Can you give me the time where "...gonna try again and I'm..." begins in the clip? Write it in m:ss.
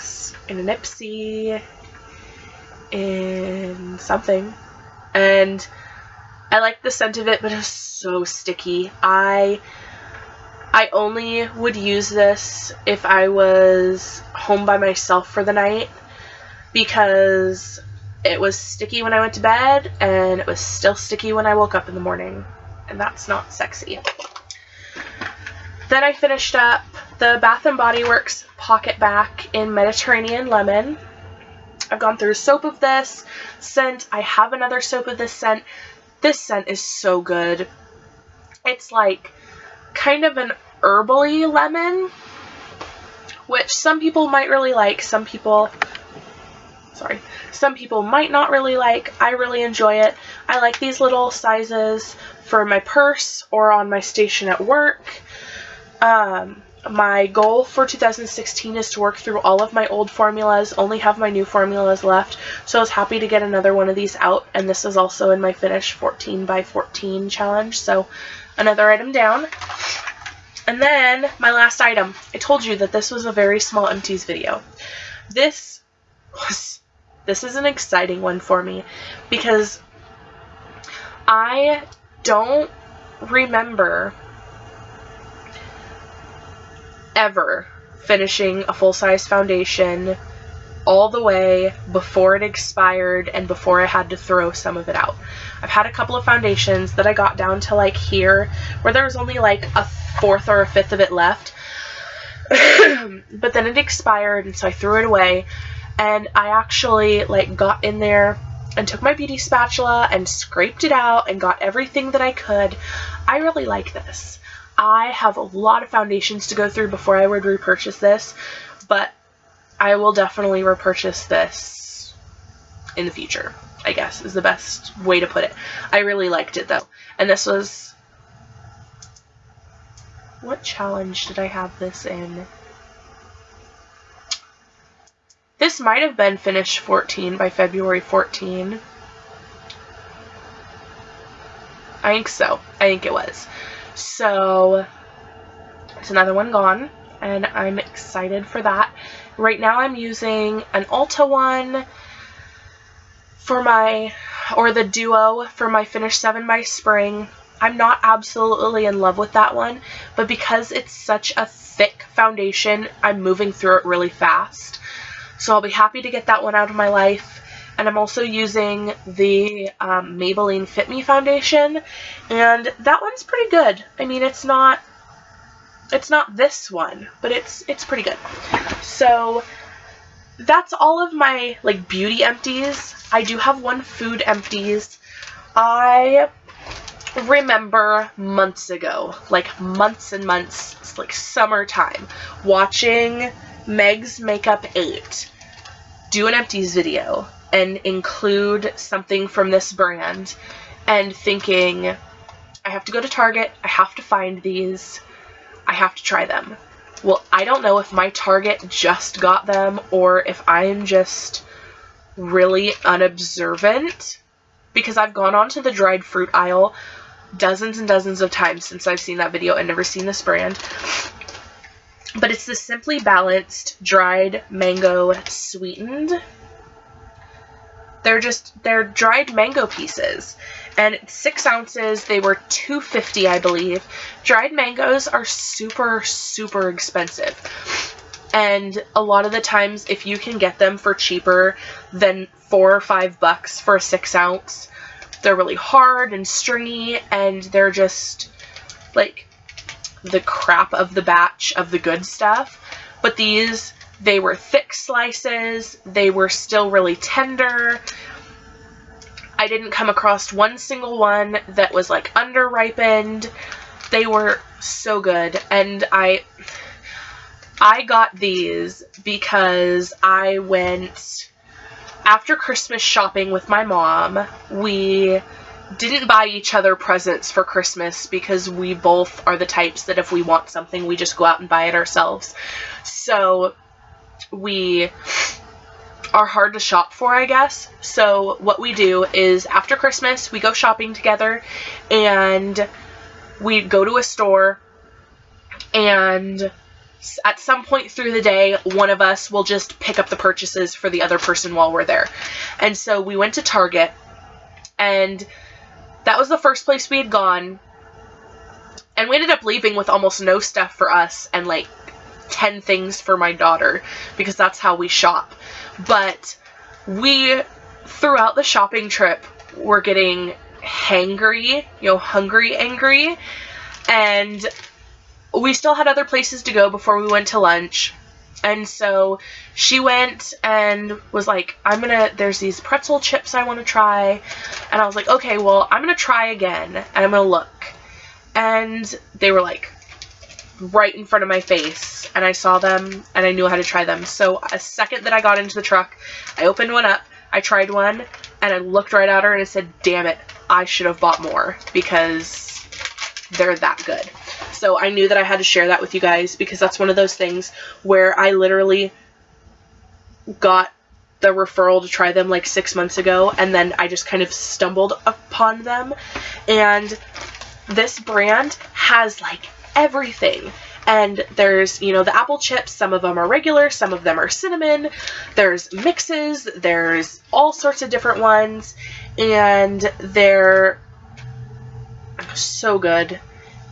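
5:35.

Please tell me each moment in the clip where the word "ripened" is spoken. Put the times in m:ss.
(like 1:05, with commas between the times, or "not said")
4:22.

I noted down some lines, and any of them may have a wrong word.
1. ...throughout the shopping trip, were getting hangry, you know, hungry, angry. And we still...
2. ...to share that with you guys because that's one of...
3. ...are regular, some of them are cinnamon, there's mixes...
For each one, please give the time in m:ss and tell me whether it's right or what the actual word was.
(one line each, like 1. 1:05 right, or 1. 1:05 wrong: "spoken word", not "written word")
1. 5:17 right
2. 5:55 right
3. 6:13 right.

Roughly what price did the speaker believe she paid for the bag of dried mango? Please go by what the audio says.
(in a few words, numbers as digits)
$2.50.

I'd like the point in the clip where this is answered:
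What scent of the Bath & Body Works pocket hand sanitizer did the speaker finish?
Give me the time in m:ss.
0:29.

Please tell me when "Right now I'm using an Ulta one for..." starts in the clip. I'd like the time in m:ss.
2:29.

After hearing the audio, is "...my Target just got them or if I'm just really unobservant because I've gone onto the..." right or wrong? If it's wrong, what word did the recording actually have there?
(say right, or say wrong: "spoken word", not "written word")
right.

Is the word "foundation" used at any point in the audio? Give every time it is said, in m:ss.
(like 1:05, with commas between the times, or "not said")
1:29, 1:36, 1:55, 2:42, 2:51.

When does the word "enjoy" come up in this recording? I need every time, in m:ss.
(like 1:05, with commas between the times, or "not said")
0:49.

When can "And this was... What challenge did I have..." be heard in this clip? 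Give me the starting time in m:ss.
2:07.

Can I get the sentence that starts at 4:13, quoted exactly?
But these they were thick slices, they were still really tender.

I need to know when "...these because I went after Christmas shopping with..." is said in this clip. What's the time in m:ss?
4:28.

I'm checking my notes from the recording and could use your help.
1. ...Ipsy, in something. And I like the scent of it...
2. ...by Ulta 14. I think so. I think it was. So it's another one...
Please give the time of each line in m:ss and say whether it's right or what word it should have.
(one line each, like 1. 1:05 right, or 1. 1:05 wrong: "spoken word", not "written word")
1. 0:00 right
2. 2:17 wrong: "February", not "Ulta".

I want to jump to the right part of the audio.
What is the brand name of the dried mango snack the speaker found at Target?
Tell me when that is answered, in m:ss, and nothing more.
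3:42.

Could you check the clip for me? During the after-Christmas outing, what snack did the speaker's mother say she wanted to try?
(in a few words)
pretzel chips.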